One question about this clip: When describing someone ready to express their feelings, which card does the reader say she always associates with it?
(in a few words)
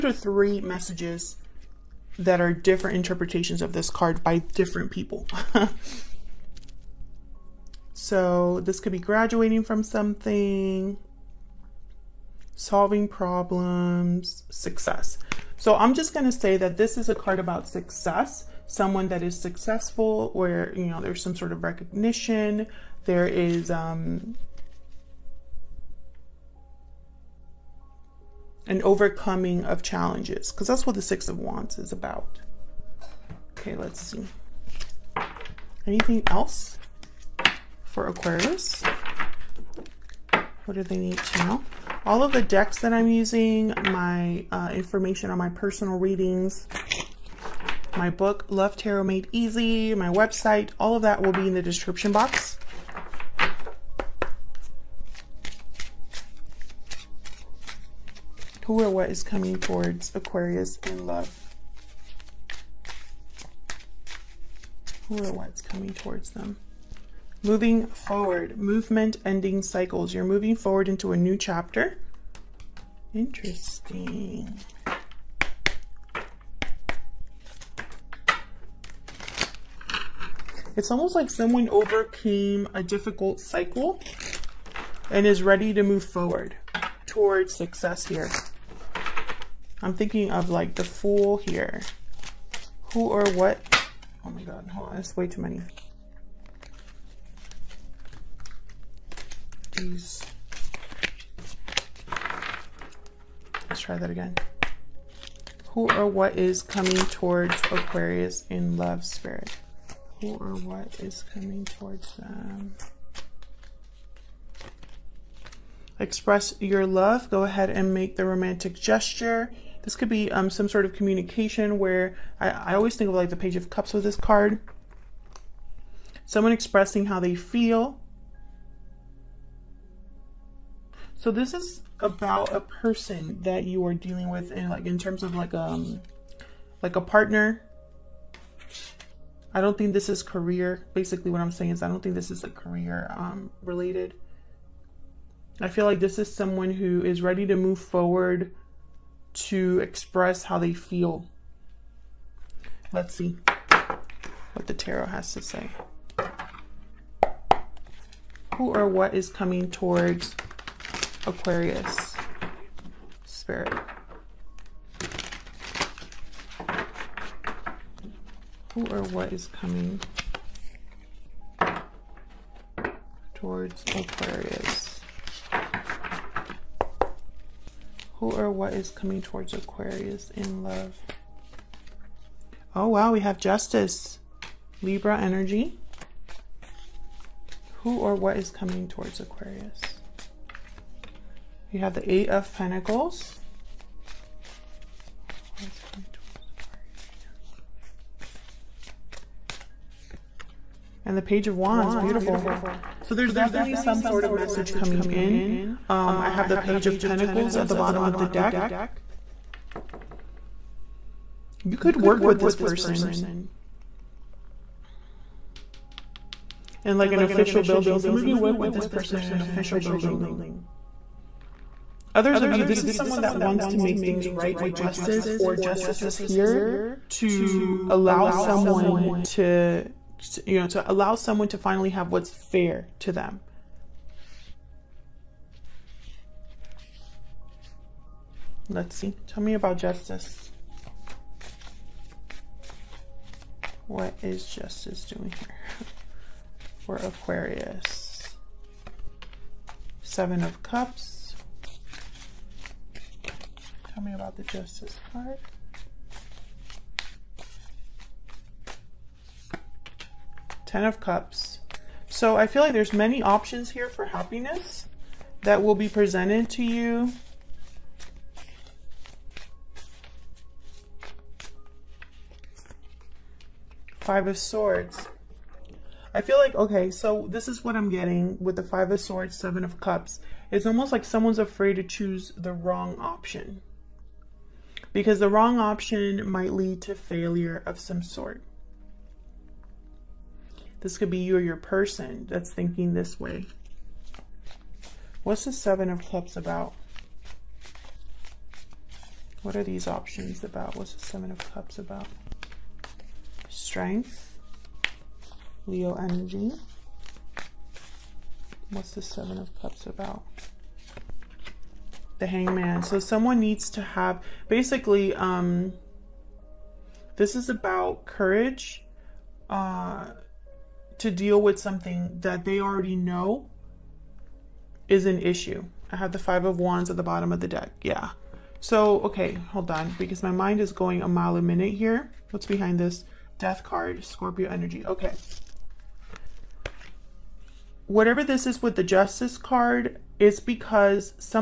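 Page of Cups.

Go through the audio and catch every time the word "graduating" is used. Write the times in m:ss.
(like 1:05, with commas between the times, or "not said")
0:08.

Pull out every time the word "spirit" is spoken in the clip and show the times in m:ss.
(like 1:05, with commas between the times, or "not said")
1:49, 2:43.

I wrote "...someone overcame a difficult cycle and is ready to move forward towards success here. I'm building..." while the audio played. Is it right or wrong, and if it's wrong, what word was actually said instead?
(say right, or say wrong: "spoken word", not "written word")
wrong: "thinking", not "building".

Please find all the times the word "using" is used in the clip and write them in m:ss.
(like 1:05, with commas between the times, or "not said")
0:43.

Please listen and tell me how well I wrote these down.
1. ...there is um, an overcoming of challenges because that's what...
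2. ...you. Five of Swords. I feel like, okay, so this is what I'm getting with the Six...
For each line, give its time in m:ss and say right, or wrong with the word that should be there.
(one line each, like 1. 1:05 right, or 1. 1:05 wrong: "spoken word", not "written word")
1. 0:23 right
2. 4:26 wrong: "Five", not "Six".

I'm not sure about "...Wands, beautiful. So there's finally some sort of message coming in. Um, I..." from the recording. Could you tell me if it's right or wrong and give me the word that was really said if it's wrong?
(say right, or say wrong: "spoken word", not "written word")
wrong: "definitely", not "finally".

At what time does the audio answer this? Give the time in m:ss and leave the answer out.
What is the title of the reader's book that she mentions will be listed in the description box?
0:48.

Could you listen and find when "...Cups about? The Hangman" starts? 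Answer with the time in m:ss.
5:09.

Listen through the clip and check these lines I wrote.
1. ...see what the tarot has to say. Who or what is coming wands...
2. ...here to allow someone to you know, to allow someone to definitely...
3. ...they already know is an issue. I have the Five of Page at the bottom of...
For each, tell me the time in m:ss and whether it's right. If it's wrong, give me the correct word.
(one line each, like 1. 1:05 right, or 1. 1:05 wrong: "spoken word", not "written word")
1. 2:33 wrong: "towards", not "wands"
2. 3:46 wrong: "finally", not "definitely"
3. 5:22 wrong: "Wands", not "Page".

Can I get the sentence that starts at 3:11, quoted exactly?
We have the Eight of Pentacles.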